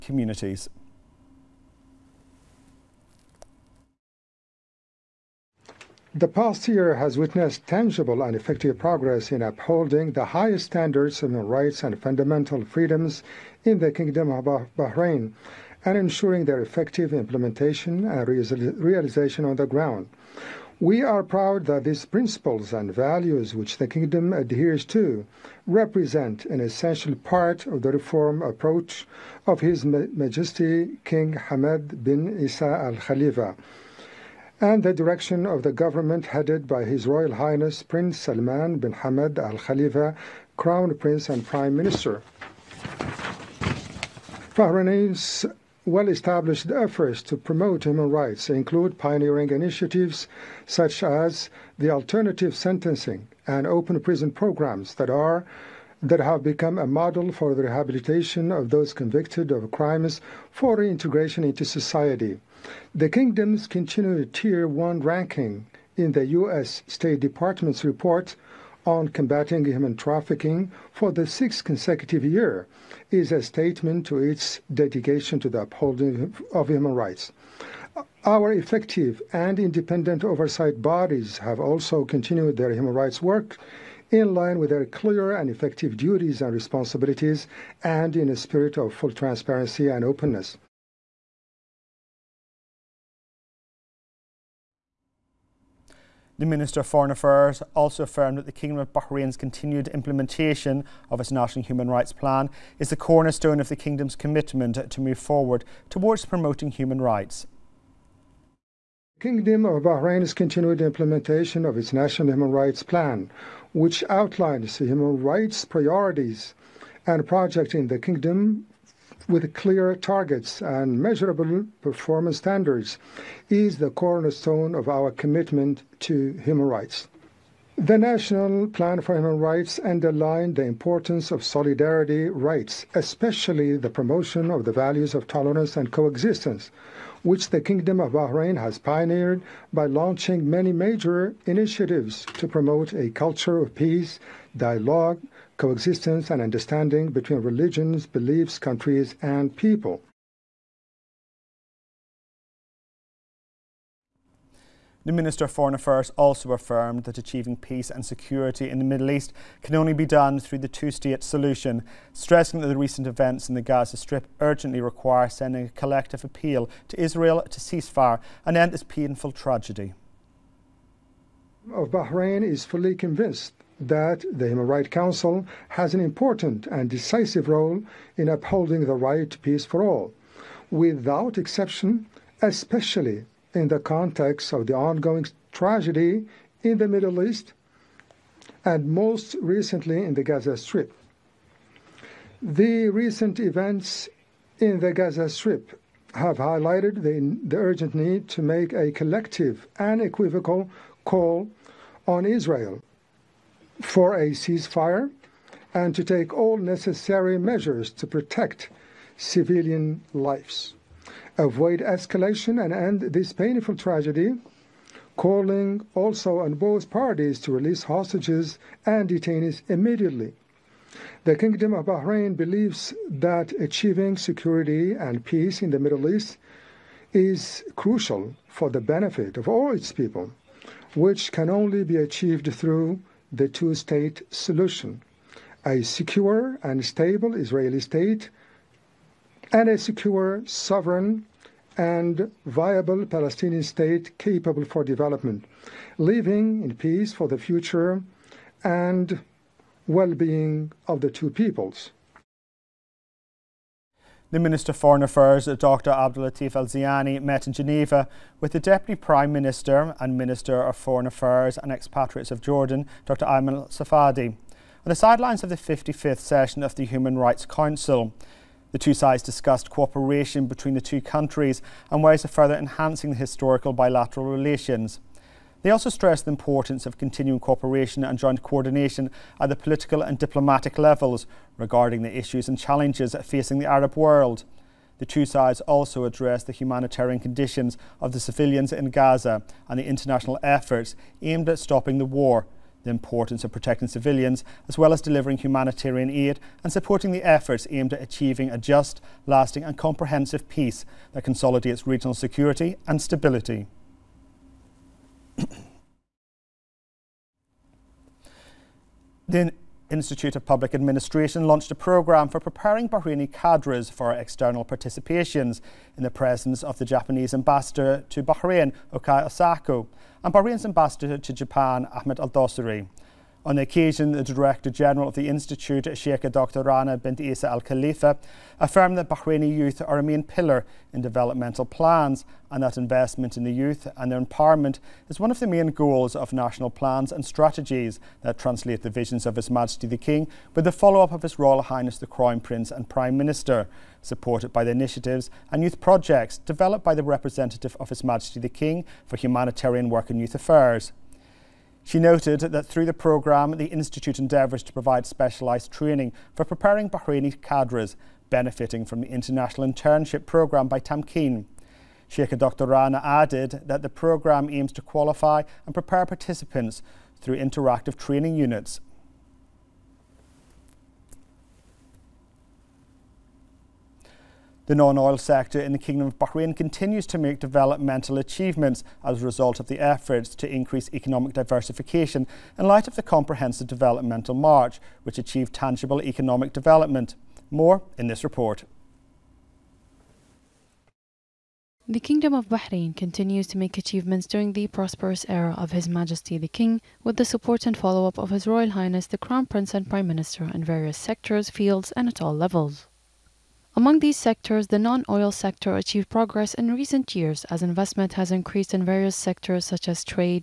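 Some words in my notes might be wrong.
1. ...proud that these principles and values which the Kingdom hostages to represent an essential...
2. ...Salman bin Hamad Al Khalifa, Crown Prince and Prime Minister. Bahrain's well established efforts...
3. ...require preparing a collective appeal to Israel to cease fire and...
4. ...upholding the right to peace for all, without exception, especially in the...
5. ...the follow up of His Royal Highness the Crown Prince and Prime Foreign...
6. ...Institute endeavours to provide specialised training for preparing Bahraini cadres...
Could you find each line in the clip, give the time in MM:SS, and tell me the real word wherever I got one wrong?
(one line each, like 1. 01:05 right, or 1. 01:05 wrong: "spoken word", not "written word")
1. 00:21 wrong: "adheres", not "hostages"
2. 00:38 right
3. 02:44 wrong: "sending", not "preparing"
4. 02:58 right
5. 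05:40 wrong: "Minister", not "Foreign"
6. 05:53 right.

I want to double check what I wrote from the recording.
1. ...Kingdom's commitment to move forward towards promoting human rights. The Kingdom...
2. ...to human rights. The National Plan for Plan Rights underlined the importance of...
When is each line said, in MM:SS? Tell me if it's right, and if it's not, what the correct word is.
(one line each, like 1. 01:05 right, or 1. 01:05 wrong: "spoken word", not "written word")
1. 01:43 right
2. 02:05 wrong: "Human", not "Plan".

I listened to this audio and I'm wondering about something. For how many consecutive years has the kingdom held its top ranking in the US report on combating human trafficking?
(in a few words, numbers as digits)
6.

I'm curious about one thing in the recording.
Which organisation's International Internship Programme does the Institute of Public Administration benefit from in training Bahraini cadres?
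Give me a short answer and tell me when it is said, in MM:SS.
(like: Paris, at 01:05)
Tamkeen, at 06:00.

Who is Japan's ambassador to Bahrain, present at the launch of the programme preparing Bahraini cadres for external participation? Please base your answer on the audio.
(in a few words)
Okai Osako.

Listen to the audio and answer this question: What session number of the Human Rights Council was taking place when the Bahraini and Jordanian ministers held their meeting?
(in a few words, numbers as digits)
55th.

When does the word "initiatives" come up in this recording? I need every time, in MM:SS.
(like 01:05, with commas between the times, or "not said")
00:49, 02:21, 05:44.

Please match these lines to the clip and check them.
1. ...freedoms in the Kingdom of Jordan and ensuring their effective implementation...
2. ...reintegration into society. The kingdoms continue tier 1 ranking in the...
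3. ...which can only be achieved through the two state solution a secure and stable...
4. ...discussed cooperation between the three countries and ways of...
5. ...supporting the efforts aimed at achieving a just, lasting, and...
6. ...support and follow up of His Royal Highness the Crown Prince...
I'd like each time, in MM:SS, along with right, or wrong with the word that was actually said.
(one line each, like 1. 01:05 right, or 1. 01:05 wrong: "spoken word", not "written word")
1. 00:12 wrong: "Bahrain", not "Jordan"
2. 01:00 right
3. 03:50 right
4. 04:29 wrong: "two", not "three"
5. 04:56 right
6. 06:37 right.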